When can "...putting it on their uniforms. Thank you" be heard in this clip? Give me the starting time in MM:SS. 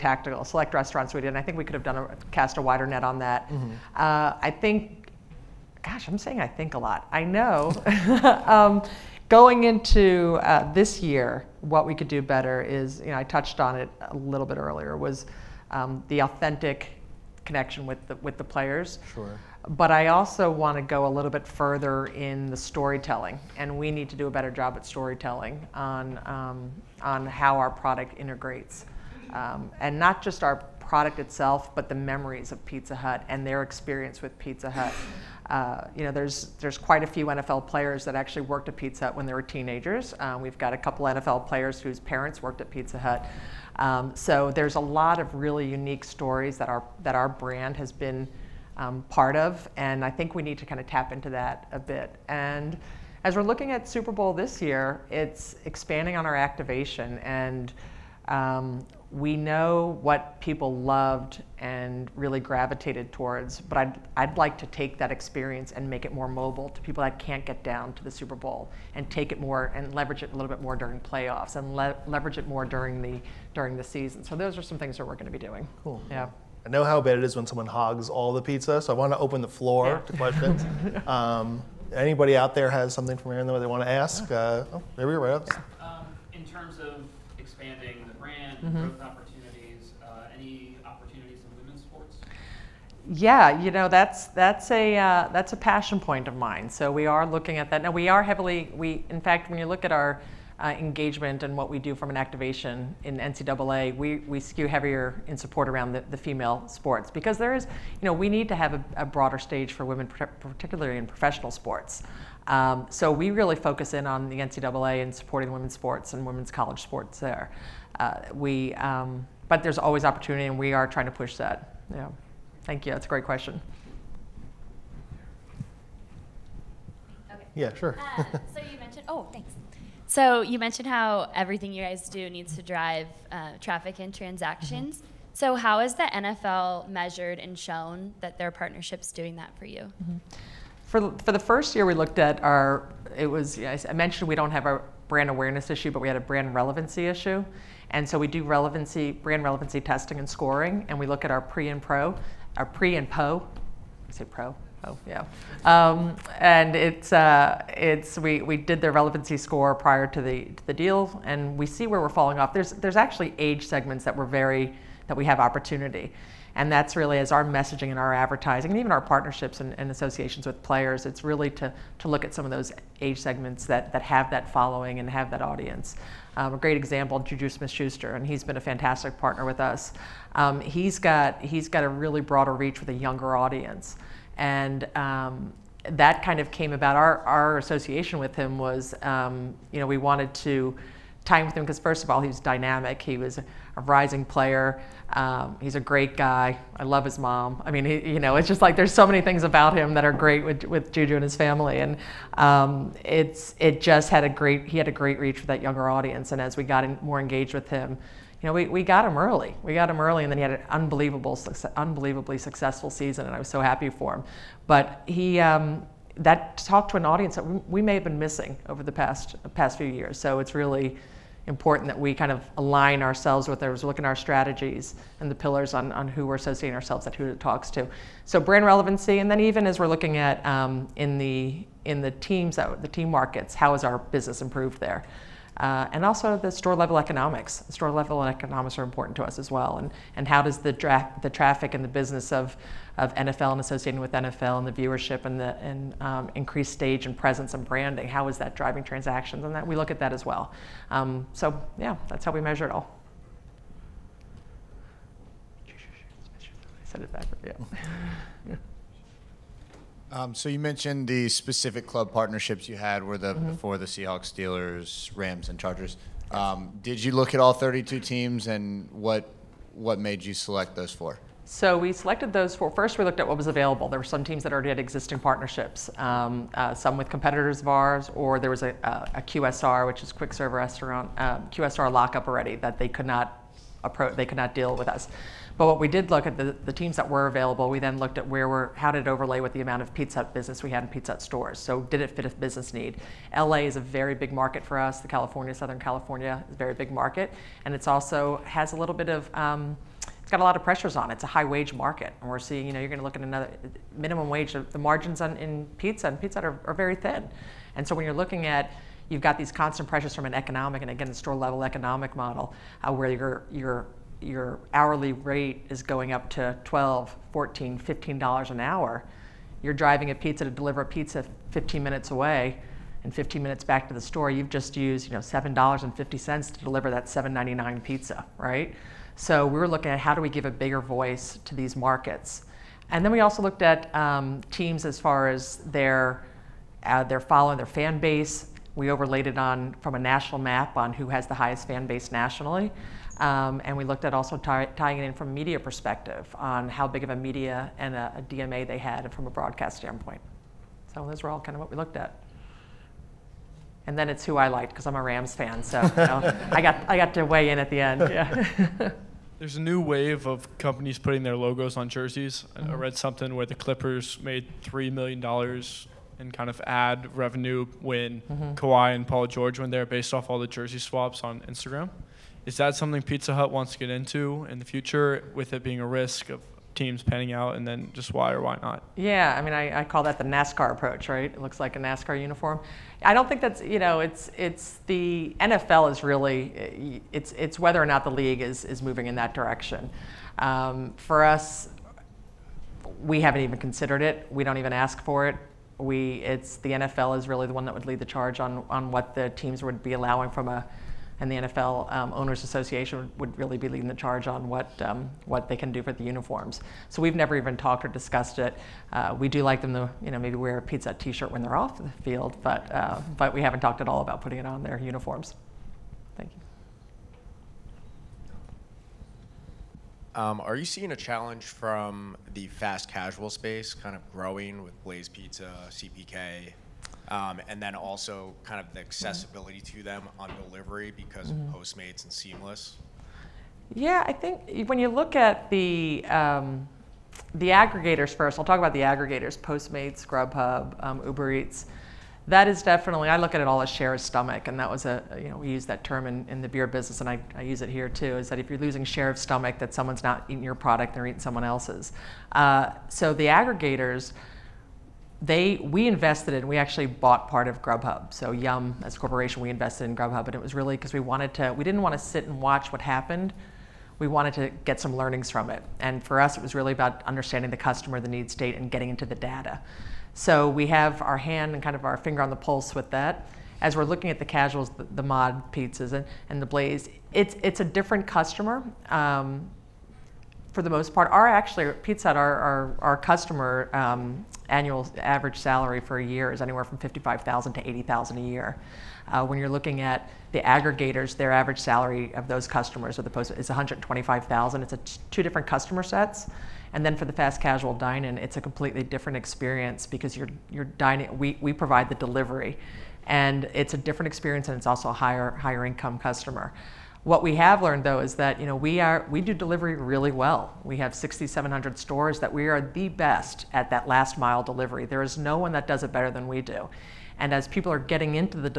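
06:54.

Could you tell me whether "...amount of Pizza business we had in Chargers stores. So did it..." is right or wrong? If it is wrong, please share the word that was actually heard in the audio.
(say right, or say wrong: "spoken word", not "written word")
wrong: "Pizza", not "Chargers".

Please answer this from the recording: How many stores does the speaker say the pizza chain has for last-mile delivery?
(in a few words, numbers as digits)
6,700.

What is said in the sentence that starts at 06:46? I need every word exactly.
So we've never even talked or discussed it.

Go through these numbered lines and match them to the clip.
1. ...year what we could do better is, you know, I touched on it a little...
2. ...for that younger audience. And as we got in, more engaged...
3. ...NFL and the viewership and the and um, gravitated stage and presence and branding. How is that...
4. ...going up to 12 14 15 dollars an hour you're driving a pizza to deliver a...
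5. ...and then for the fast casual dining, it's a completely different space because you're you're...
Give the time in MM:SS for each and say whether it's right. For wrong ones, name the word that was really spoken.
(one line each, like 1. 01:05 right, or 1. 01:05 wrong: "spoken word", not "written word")
1. 00:11 right
2. 03:25 right
3. 04:04 wrong: "increased", not "gravitated"
4. 05:15 right
5. 08:16 wrong: "experience", not "space".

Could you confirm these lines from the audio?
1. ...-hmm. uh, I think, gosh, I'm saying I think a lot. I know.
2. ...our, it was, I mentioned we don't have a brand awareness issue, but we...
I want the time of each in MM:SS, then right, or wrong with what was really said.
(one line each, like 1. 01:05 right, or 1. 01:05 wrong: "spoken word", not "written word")
1. 00:03 right
2. 02:22 right.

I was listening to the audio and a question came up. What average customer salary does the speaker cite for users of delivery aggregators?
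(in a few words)
125,000.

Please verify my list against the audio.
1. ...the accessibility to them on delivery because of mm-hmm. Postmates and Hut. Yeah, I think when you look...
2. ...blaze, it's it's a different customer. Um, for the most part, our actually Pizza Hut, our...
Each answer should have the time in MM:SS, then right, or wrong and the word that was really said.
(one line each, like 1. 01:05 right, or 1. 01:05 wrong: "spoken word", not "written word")
1. 07:08 wrong: "Seamless", not "Hut"
2. 07:56 right.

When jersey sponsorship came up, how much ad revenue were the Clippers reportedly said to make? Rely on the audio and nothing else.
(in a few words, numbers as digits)
$3 million.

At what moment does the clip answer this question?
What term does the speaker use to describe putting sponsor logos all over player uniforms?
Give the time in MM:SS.
06:20.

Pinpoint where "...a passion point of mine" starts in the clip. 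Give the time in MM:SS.
01:35.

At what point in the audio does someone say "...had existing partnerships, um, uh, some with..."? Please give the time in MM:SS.
04:34.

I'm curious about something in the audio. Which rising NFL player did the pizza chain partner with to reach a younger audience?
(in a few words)
Juju Smith-Schuster.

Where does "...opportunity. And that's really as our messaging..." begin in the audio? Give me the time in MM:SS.
02:45.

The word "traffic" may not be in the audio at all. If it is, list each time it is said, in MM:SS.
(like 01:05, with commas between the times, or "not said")
02:13, 04:01.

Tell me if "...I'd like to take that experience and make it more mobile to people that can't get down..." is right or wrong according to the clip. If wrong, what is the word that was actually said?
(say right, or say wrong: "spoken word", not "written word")
right.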